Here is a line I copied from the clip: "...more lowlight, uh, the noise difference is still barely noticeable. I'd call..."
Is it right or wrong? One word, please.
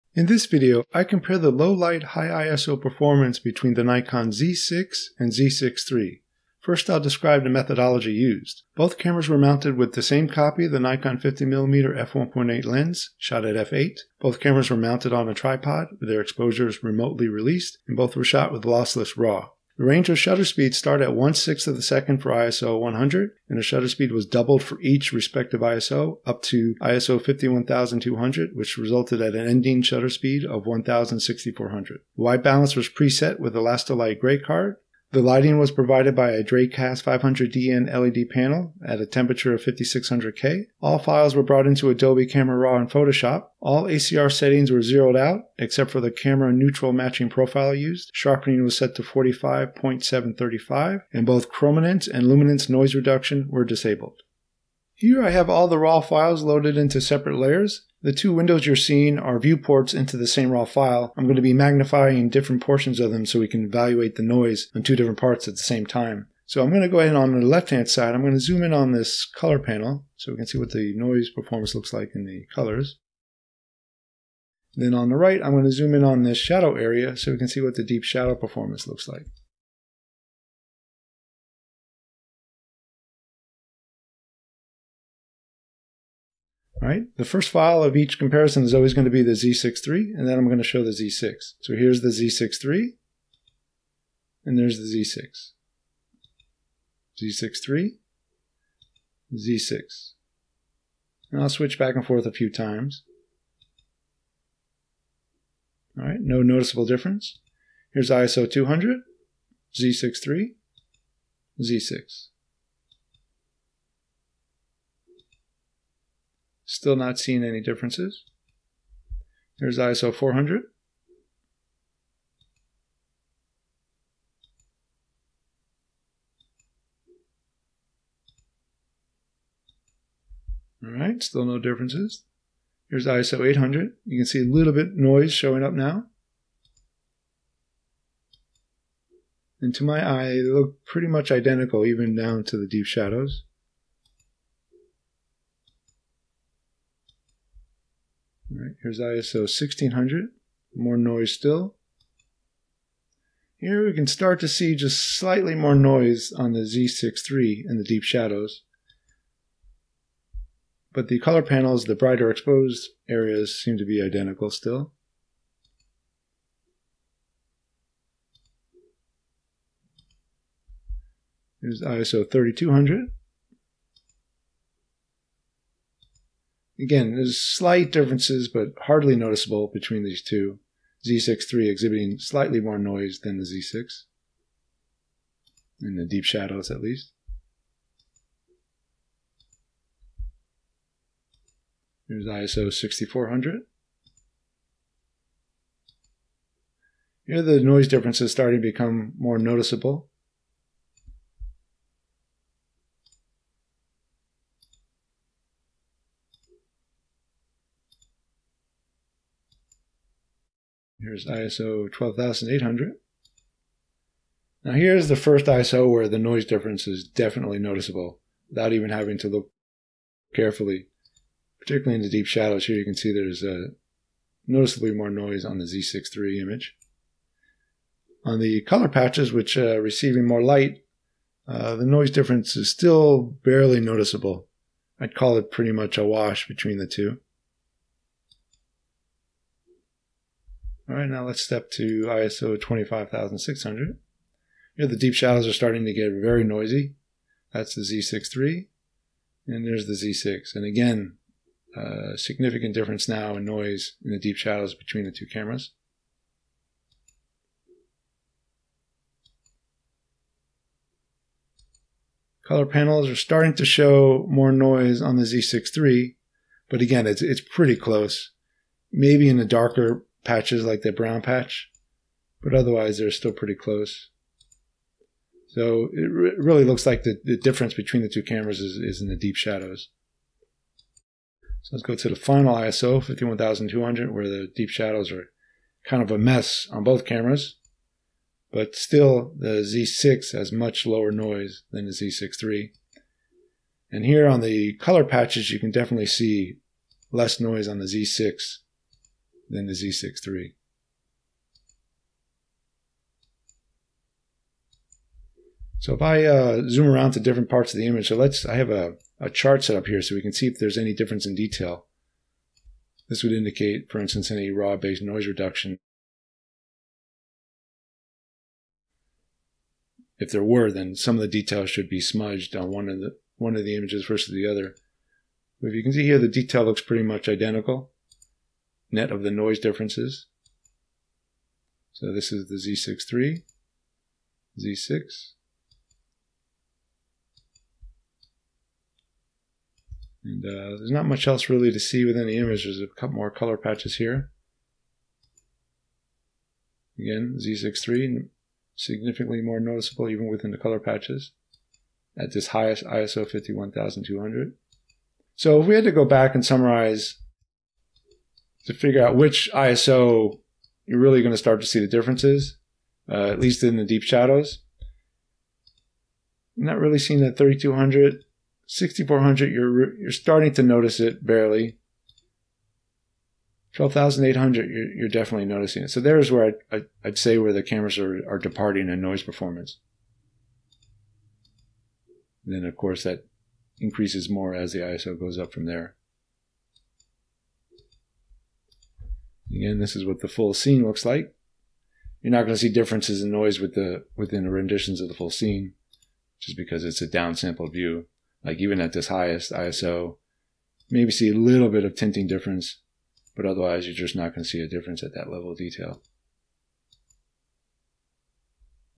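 wrong.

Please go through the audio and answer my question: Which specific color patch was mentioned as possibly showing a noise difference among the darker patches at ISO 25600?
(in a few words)
brown patch.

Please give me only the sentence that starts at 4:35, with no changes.
So it re- really looks like the, the difference between the two cameras is, is in the deep shadows.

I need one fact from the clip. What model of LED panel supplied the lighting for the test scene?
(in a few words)
Dracast 500DN.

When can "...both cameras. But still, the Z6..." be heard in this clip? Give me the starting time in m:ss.
4:46.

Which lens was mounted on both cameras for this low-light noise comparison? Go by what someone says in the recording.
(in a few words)
Nikon 50mm f1.8.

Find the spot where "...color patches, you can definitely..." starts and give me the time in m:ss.
4:54.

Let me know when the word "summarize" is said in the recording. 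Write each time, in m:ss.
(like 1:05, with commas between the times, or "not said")
5:56.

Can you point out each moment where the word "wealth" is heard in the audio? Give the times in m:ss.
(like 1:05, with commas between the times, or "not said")
not said.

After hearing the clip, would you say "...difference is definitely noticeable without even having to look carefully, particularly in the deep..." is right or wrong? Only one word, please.
right.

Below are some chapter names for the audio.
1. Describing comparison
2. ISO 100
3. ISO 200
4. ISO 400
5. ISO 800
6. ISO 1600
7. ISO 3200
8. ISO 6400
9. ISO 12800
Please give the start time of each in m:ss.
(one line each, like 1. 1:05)
1. 0:54
2. 1:31
3. 1:47
4. 1:59
5. 2:12
6. 2:28
7. 2:51
8. 3:12
9. 3:31.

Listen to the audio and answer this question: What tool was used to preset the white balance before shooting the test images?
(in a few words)
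Lastolite gray card.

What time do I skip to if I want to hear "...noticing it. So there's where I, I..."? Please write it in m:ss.
6:15.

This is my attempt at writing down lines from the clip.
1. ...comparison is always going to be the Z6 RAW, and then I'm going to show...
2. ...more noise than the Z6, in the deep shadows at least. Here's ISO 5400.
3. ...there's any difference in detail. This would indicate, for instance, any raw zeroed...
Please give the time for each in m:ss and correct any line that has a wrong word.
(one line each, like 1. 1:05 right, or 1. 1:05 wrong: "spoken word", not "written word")
1. 1:28 wrong: "III", not "RAW"
2. 3:02 wrong: "6400", not "5400"
3. 5:10 wrong: "based", not "zeroed".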